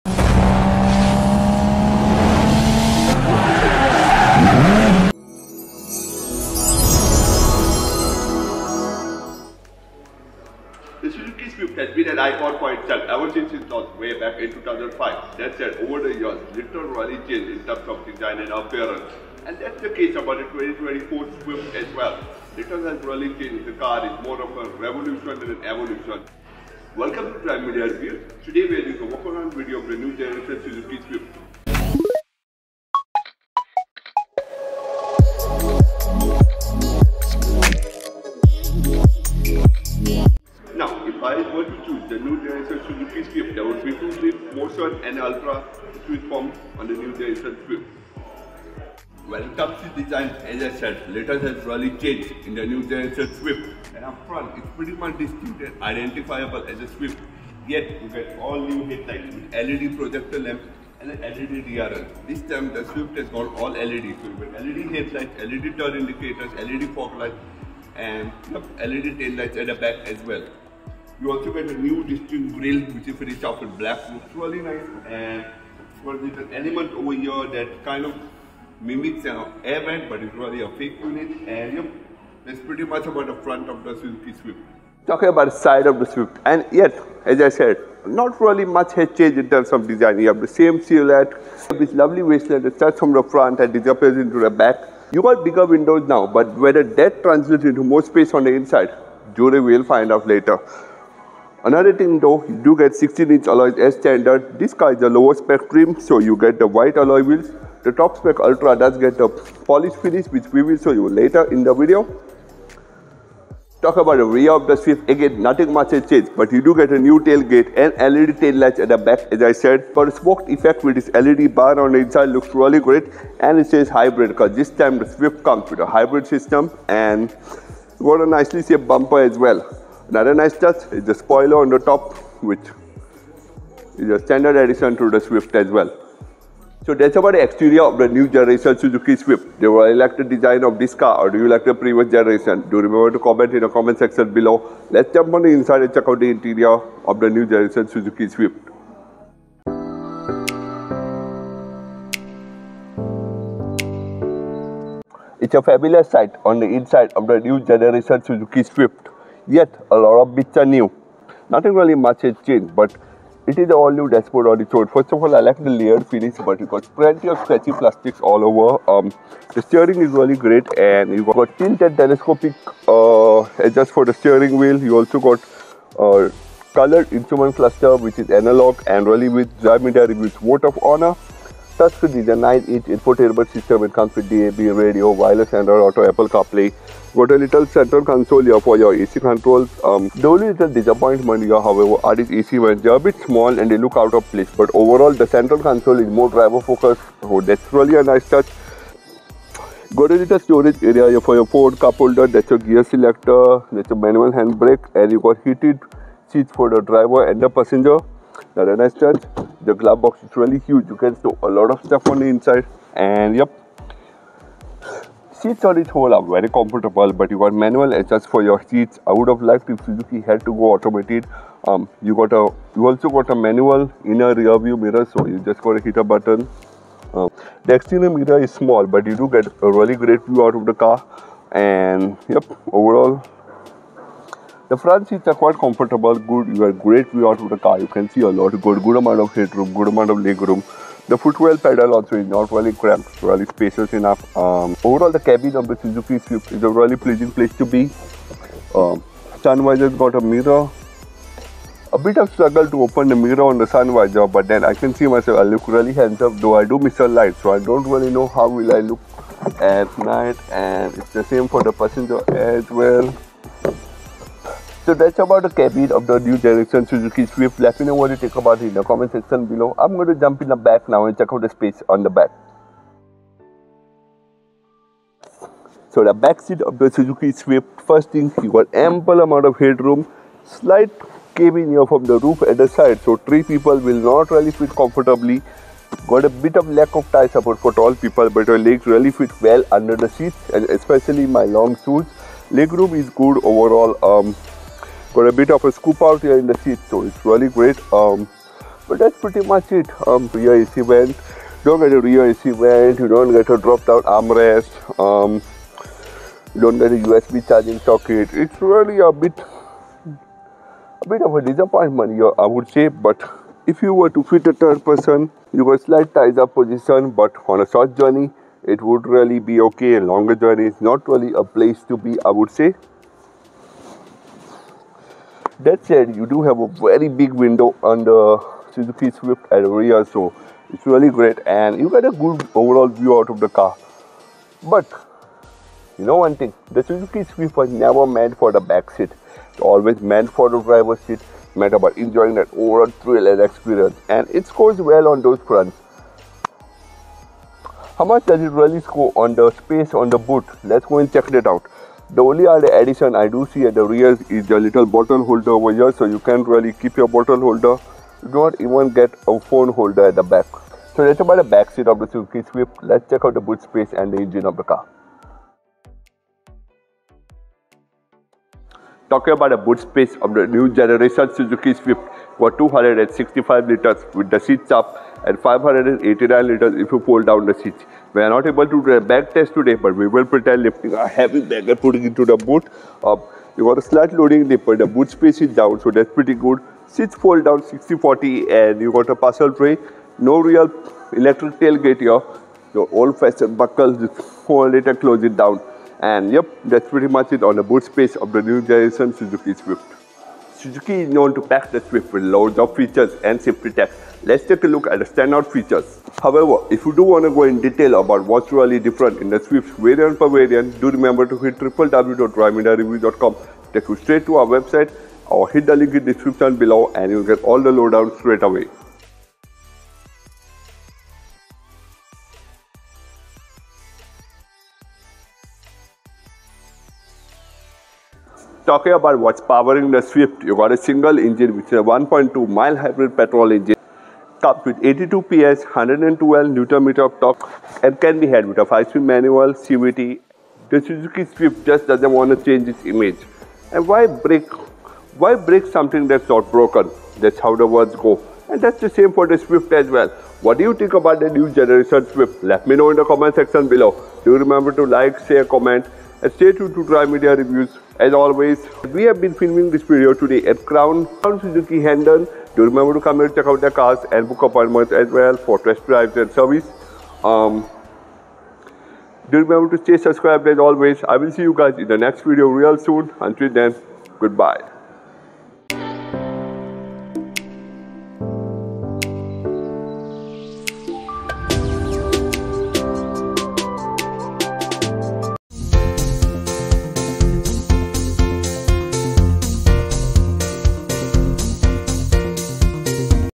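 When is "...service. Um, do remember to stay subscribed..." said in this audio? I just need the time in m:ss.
7:46.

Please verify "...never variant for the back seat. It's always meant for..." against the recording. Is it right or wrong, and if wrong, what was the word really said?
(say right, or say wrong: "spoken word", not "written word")
wrong: "meant", not "variant".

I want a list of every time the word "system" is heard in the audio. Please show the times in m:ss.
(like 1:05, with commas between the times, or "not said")
2:06, 3:03.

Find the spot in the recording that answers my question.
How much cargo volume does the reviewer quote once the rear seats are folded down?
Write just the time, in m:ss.
6:15.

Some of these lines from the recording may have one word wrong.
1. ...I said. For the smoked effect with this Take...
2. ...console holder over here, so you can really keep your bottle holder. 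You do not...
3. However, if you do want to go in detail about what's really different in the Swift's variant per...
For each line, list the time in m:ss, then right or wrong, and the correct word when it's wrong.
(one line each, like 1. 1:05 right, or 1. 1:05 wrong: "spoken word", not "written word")
1. 1:59 wrong: "LED", not "Take"
2. 5:54 wrong: "bottle", not "console"
3. 6:46 right.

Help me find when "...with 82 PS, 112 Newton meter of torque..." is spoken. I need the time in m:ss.
7:14.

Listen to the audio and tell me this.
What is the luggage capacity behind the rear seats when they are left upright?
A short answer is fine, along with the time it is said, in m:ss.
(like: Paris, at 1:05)
265 liters, at 6:12.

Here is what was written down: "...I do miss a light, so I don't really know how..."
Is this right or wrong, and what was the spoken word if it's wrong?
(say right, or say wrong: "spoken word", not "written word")
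right.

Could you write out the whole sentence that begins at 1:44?
This car is the lower spec trim, so you get the white alloy wheels.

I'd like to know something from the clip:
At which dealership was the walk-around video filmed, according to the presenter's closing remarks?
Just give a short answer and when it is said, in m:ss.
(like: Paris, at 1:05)
Crown Suzuki Hendon, at 7:41.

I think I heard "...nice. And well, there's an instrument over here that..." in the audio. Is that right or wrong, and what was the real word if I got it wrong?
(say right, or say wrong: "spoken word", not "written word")
wrong: "element", not "instrument".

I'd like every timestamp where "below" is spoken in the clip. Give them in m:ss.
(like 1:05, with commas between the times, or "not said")
2:24, 4:29, 6:56, 7:33.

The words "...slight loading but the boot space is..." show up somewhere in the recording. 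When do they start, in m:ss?
6:23.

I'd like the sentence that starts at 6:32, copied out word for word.
Your old-fashioned buckles, just hold it and close it down.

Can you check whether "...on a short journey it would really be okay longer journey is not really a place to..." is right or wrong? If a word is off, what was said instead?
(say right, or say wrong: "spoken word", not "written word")
right.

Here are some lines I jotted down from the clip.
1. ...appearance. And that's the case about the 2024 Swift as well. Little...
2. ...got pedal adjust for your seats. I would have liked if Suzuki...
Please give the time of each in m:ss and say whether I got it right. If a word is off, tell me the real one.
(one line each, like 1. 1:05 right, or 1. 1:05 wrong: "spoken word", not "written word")
1. 0:18 right
2. 3:37 wrong: "manual", not "pedal".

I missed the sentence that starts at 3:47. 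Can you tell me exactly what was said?
Um, the exterior mirror is small, but you do get a really great view out of the car.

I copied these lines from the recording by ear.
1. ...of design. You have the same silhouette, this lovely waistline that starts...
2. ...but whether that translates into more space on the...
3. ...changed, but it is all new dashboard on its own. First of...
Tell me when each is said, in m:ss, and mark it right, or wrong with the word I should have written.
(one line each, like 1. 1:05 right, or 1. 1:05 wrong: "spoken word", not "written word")
1. 1:29 right
2. 1:36 right
3. 2:42 right.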